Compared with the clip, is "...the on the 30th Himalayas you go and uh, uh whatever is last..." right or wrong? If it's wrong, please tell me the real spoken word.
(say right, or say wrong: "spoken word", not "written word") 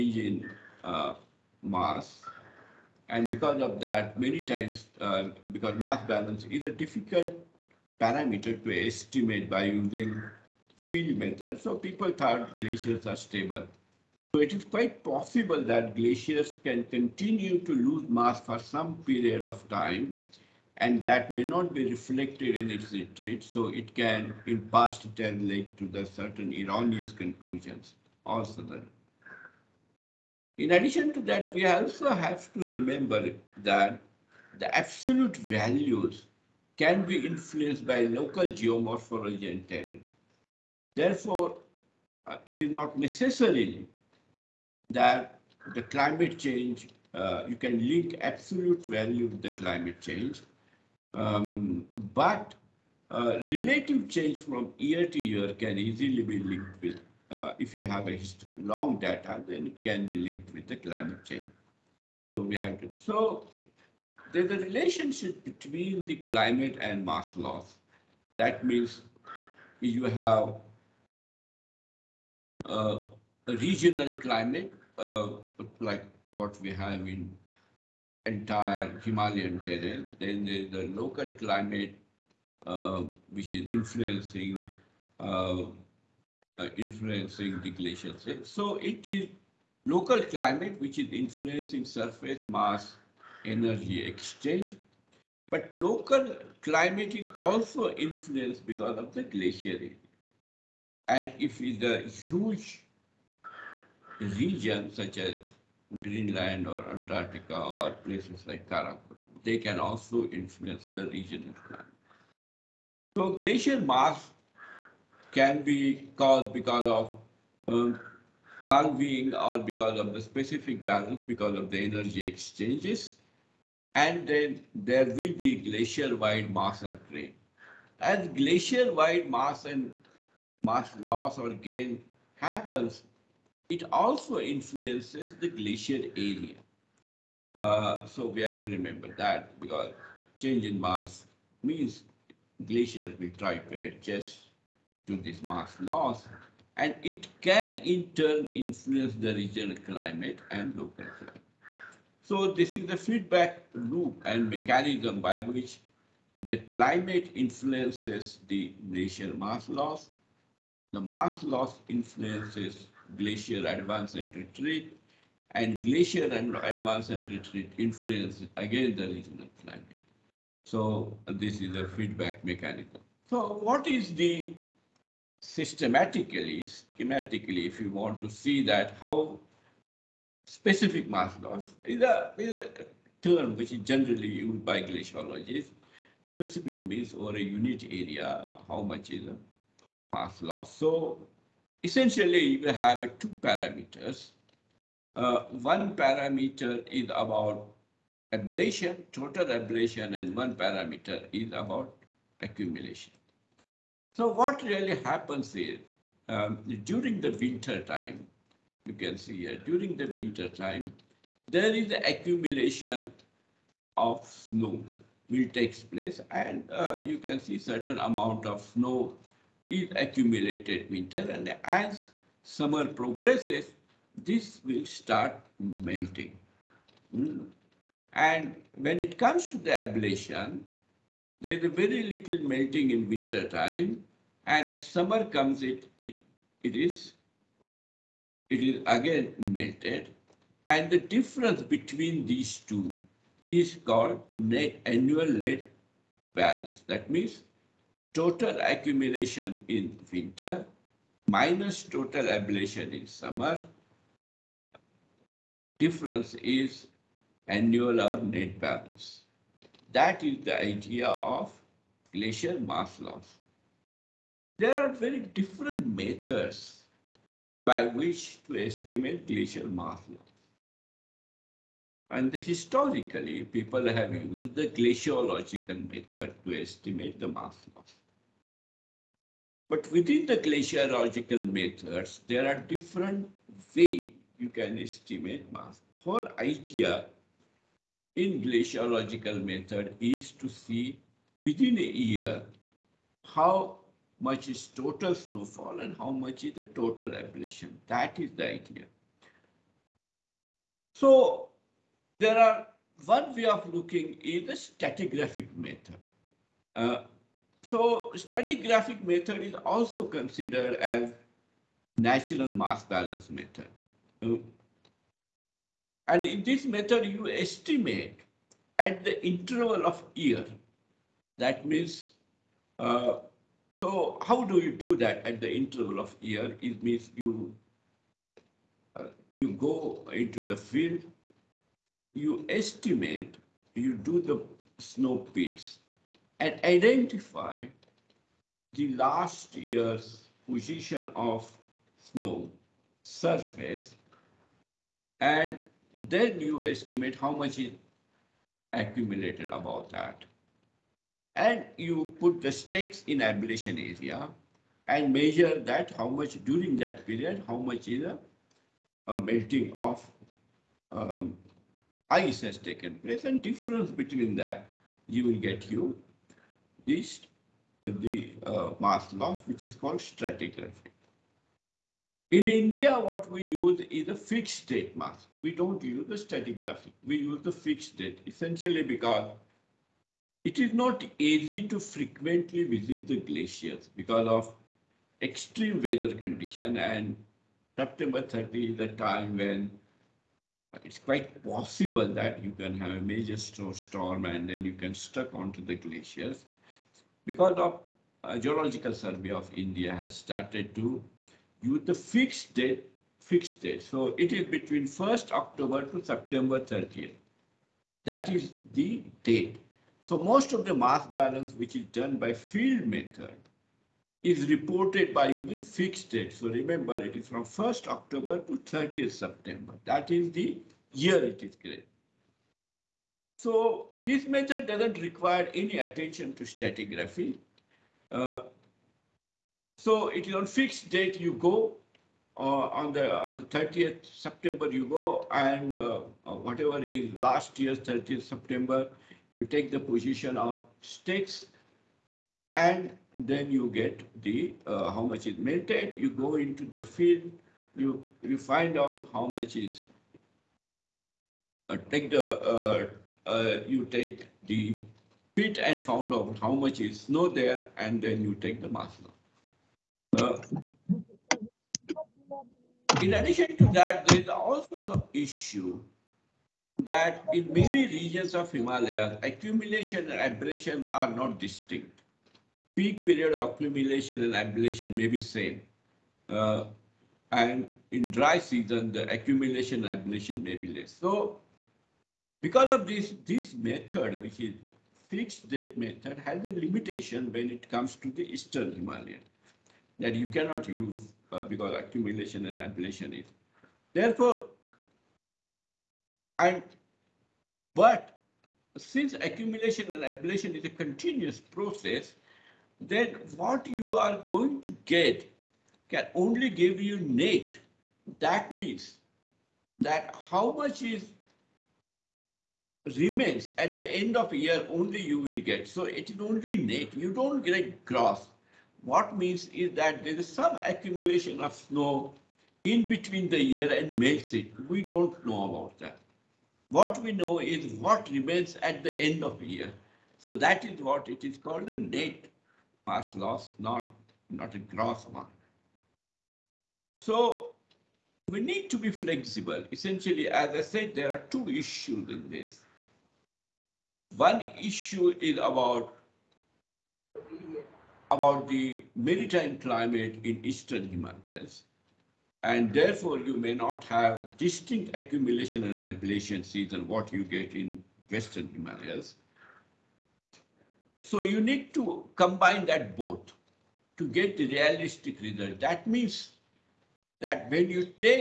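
wrong: "September", not "Himalayas".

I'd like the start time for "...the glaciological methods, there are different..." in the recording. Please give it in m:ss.
4:40.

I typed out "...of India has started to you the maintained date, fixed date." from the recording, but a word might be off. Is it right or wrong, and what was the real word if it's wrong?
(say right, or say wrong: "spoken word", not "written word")
wrong: "fixed", not "maintained".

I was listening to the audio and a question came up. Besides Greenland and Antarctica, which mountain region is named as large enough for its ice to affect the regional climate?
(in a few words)
Karakoram.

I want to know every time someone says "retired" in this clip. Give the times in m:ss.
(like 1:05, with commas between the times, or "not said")
not said.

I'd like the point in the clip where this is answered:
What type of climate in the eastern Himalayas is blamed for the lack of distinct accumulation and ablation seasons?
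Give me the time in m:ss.
9:08.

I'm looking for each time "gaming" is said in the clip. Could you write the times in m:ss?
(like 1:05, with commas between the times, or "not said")
not said.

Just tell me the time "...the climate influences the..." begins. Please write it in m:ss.
2:36.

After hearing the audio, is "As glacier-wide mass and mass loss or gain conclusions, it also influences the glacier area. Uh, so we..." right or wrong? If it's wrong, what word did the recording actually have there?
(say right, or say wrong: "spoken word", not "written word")
wrong: "happens", not "conclusions".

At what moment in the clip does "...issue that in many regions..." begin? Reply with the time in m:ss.
7:45.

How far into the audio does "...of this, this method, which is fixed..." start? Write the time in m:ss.
8:02.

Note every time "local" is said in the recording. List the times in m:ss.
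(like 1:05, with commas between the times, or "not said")
0:38, 1:20, 1:29, 1:35, 2:30.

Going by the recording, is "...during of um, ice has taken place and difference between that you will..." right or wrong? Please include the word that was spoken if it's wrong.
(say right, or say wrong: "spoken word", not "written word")
wrong: "melting", not "during".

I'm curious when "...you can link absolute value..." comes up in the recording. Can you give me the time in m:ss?
0:47.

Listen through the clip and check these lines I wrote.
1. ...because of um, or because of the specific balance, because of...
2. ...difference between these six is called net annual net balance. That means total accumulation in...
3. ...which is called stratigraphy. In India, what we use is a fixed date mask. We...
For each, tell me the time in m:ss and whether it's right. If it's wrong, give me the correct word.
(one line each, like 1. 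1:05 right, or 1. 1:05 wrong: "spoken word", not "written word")
1. 1:56 right
2. 4:01 wrong: "two", not "six"
3. 6:09 right.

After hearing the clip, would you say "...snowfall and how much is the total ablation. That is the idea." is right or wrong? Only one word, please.
right.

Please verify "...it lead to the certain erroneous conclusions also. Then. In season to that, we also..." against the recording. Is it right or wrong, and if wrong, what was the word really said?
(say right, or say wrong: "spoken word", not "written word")
wrong: "addition", not "season".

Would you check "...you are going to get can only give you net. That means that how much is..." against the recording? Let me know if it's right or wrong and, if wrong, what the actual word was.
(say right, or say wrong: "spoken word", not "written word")
right.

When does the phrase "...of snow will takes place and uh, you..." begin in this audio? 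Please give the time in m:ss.
3:33.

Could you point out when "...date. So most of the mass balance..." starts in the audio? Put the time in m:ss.
6:49.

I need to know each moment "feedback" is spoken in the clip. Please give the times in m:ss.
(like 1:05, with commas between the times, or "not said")
2:32, 2:51.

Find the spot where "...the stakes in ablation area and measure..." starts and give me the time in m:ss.
5:52.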